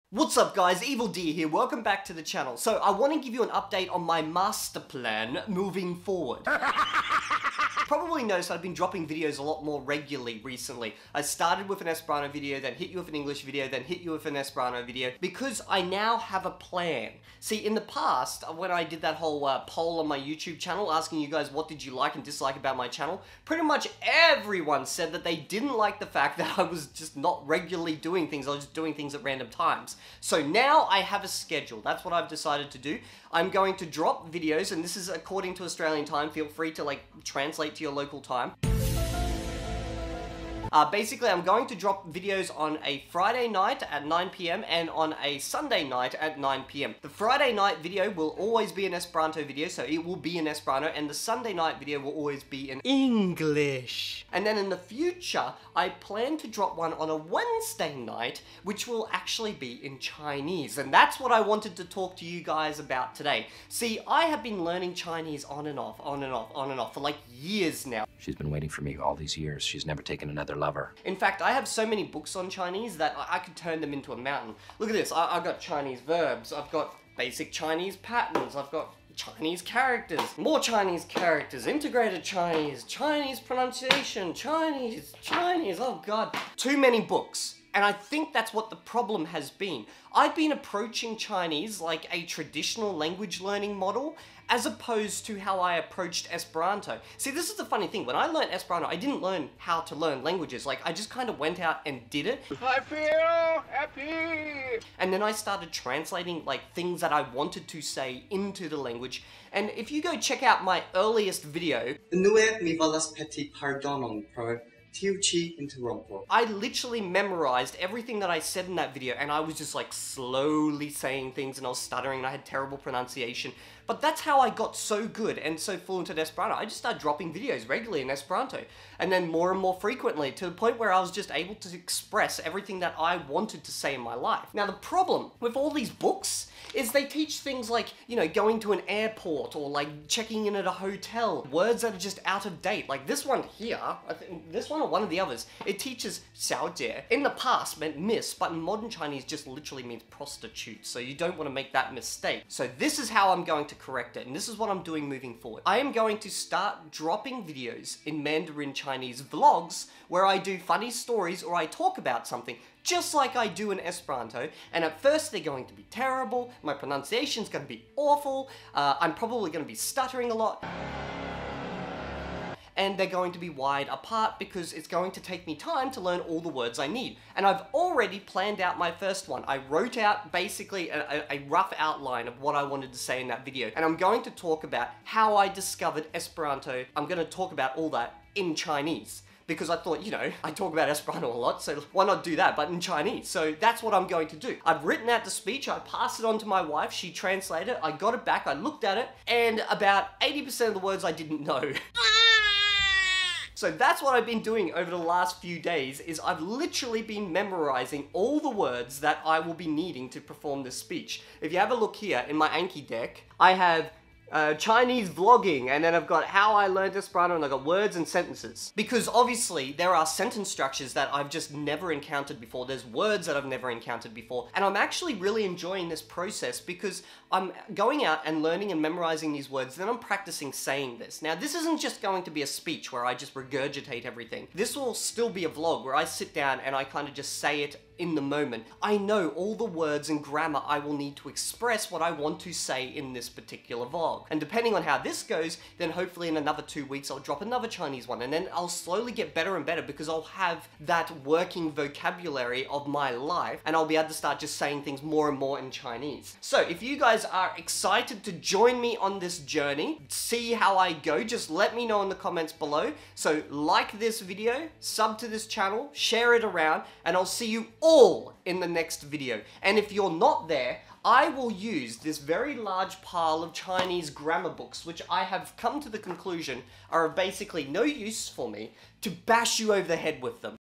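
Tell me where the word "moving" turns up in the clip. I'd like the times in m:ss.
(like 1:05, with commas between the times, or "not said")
0:05, 2:35.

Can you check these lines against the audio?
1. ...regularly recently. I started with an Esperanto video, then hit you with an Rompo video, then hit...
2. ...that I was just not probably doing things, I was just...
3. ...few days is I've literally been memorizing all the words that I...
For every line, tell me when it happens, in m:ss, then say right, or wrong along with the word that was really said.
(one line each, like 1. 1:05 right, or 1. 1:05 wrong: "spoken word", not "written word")
1. 0:09 wrong: "English", not "Rompo"
2. 0:26 wrong: "regularly", not "probably"
3. 3:25 right.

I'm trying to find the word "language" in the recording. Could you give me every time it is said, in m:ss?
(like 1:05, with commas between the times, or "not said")
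1:32, 1:40, 1:48.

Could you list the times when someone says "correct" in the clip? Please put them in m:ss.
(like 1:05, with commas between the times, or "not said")
2:33.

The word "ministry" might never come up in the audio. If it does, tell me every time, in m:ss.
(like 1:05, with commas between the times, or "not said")
not said.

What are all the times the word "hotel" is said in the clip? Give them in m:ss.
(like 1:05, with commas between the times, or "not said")
2:20.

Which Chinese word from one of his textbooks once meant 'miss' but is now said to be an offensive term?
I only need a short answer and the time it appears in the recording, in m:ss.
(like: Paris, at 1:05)
xiaojie, at 2:26.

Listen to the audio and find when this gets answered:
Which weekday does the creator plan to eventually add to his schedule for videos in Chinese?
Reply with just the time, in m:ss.
0:57.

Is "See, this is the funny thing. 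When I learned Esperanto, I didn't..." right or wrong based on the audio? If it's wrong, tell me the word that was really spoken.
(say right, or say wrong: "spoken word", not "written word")
right.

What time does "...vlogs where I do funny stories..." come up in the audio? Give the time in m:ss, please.
2:39.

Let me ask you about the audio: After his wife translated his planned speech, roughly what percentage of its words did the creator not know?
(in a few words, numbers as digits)
80%.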